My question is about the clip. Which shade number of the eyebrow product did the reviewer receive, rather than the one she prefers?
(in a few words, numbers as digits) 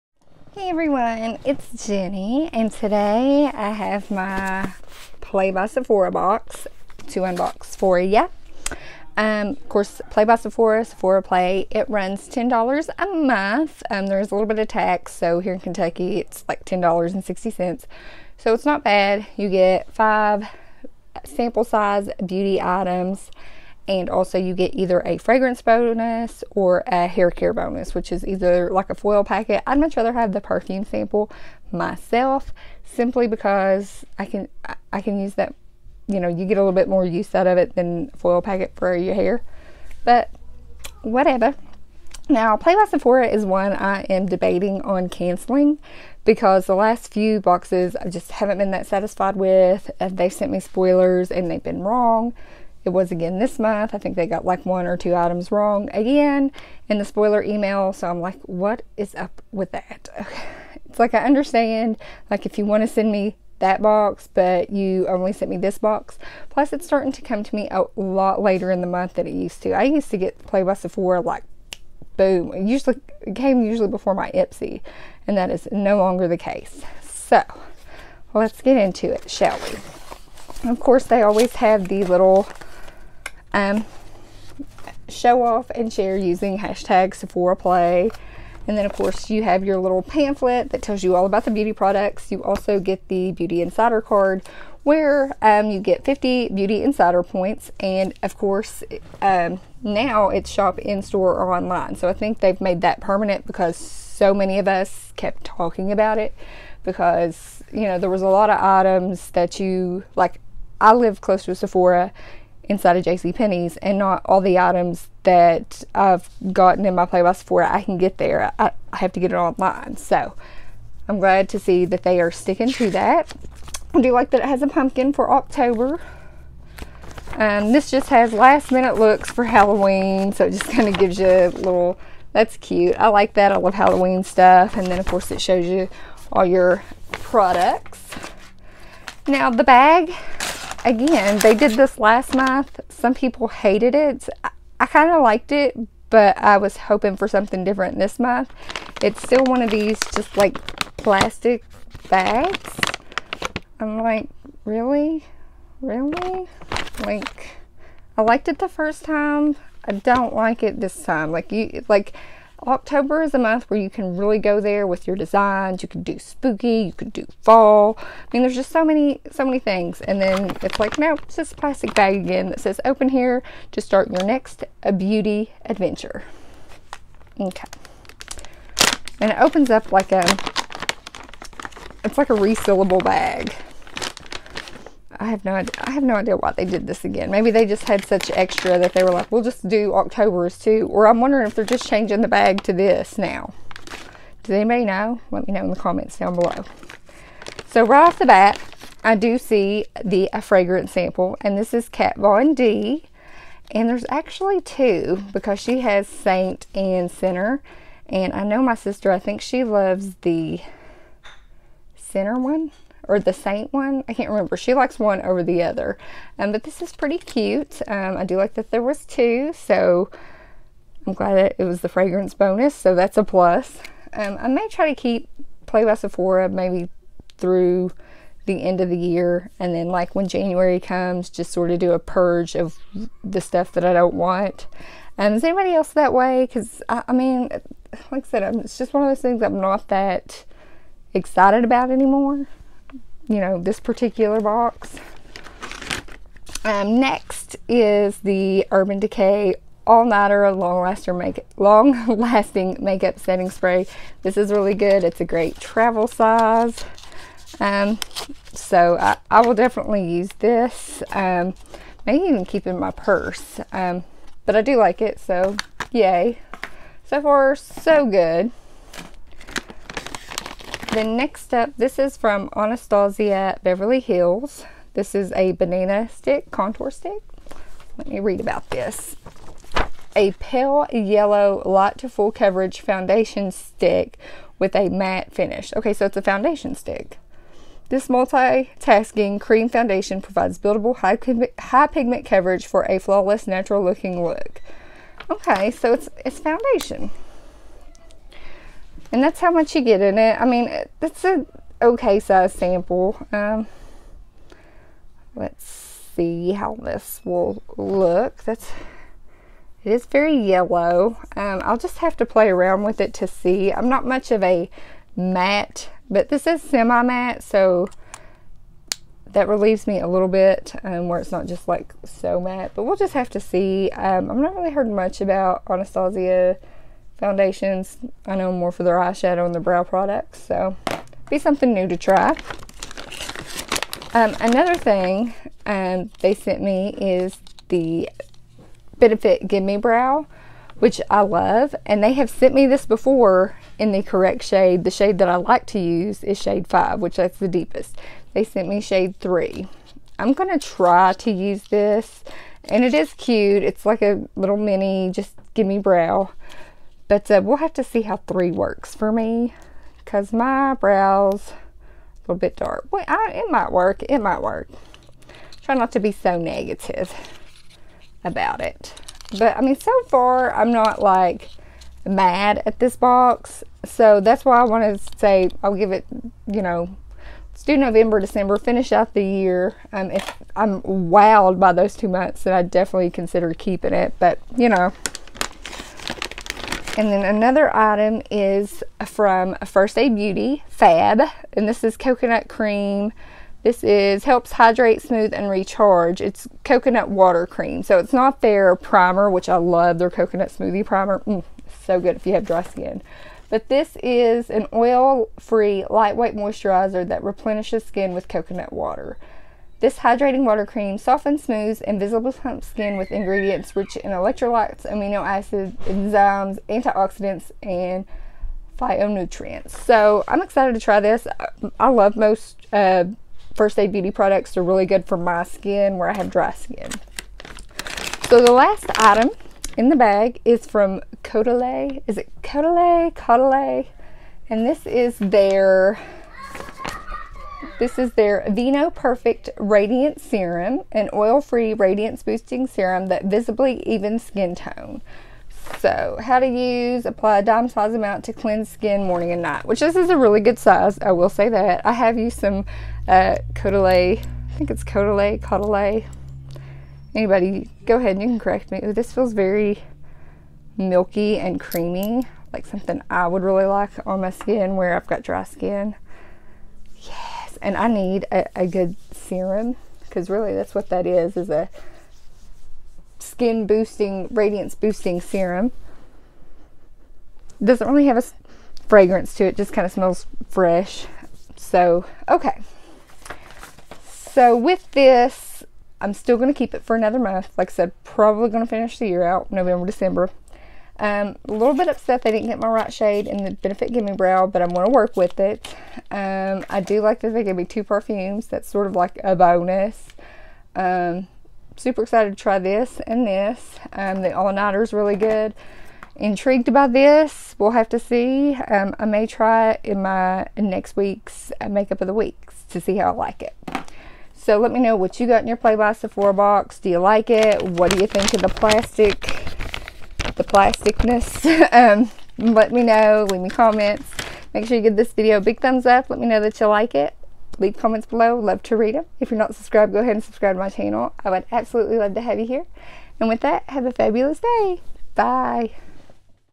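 3.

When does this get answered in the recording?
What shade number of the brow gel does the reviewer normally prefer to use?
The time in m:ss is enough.
5:46.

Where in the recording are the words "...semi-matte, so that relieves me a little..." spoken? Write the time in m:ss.
5:16.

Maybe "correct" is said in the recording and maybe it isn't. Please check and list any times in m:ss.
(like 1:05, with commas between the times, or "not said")
5:44, 7:38.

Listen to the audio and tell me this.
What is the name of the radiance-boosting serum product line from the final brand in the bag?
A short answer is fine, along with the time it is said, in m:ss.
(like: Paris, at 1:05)
Vinoperfect, at 7:18.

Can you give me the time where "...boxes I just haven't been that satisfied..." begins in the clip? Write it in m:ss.
0:47.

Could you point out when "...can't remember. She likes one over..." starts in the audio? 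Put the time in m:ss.
3:34.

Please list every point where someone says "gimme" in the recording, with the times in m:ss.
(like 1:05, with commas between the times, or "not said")
5:39, 5:55, 8:13.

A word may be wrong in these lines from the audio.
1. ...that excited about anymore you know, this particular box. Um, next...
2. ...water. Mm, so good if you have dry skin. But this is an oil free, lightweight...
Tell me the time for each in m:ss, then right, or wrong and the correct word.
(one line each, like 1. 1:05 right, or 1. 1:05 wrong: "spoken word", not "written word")
1. 3:59 right
2. 6:40 wrong: "primer", not "water".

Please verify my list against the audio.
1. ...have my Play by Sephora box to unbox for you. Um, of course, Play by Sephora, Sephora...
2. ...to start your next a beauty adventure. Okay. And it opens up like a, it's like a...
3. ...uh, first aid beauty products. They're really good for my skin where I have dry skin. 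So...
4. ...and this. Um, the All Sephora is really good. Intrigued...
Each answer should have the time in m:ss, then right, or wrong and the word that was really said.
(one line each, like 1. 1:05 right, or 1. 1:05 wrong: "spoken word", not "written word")
1. 0:03 right
2. 2:53 right
3. 7:02 right
4. 8:23 wrong: "Nighter", not "Sephora".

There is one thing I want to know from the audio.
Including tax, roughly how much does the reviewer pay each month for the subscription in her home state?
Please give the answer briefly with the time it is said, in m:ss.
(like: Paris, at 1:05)
$10.60, at 0:16.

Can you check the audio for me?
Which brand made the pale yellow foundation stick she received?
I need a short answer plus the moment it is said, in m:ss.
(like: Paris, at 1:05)
Anastasia Beverly Hills, at 4:32.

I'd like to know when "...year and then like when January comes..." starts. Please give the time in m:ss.
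3:48.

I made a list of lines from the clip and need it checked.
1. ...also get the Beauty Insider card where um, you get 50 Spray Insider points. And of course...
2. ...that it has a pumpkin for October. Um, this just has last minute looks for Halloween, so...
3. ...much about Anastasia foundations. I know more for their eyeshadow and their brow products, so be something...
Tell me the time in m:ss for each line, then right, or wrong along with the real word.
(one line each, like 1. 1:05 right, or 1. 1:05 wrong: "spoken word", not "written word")
1. 1:32 wrong: "Beauty", not "Spray"
2. 2:04 right
3. 5:24 right.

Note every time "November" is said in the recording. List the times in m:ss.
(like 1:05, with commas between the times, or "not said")
6:17, 8:09.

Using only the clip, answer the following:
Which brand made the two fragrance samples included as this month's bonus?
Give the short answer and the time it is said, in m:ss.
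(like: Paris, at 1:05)
Kat Von D, at 3:21.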